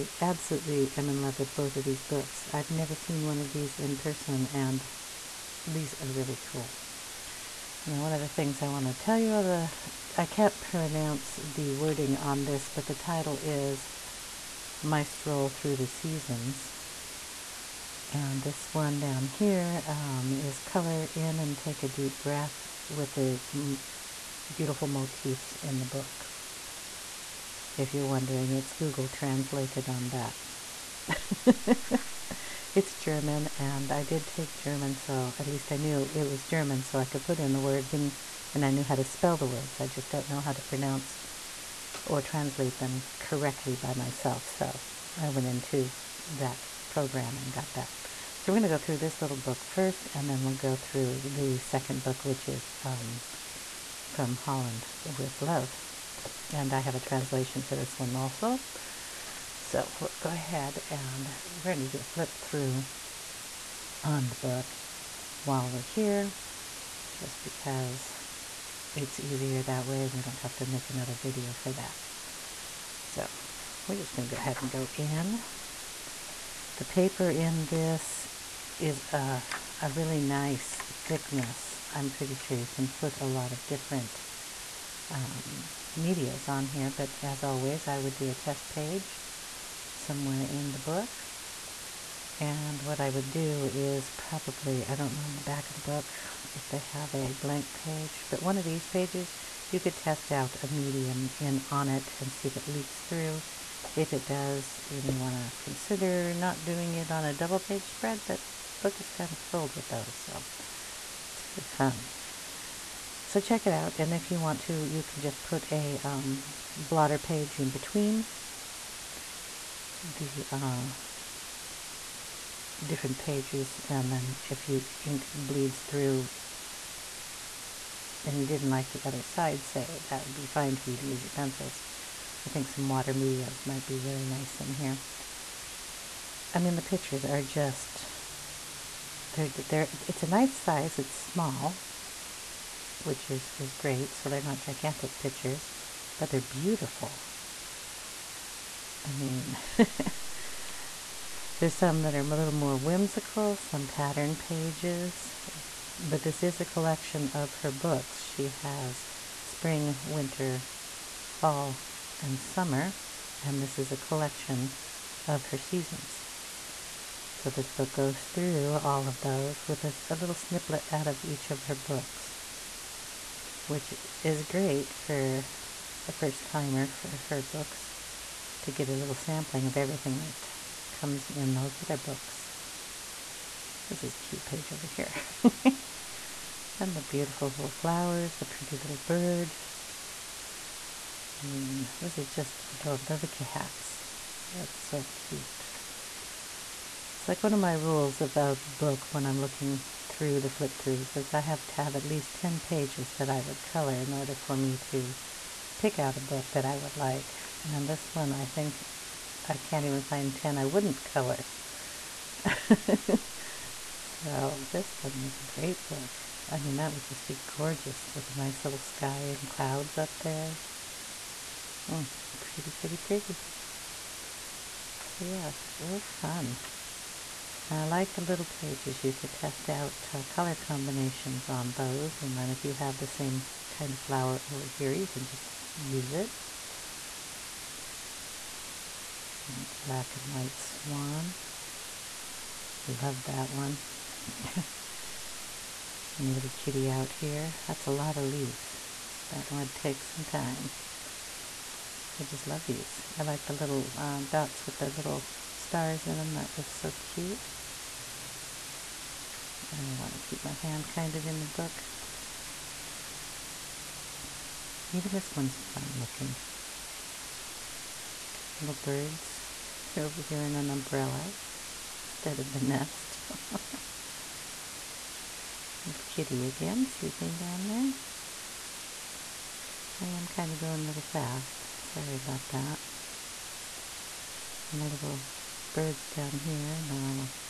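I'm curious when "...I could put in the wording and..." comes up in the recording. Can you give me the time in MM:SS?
00:36.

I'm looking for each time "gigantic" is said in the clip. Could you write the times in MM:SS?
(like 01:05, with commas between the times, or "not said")
02:24.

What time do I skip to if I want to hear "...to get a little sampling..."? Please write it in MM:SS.
02:58.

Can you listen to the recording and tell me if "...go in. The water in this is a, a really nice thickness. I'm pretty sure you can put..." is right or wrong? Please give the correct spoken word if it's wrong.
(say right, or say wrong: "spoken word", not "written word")
wrong: "paper", not "water".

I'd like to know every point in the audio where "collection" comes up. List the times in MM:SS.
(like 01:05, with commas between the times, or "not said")
02:36, 02:43.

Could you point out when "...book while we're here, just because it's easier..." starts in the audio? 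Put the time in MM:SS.
01:04.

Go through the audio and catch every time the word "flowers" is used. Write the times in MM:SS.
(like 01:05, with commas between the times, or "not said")
03:07, 03:53.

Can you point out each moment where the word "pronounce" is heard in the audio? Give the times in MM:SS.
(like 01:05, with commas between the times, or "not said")
00:10, 00:40.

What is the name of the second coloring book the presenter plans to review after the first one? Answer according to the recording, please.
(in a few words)
From Holland with Love.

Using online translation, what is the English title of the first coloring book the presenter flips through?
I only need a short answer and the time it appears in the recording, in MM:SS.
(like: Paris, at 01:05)
My Stroll Through the Seasons, at 00:14.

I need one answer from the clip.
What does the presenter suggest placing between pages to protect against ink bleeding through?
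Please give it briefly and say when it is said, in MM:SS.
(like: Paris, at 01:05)
Blotter page, at 01:56.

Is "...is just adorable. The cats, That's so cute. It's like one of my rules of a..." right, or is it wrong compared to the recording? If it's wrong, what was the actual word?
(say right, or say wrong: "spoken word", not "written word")
right.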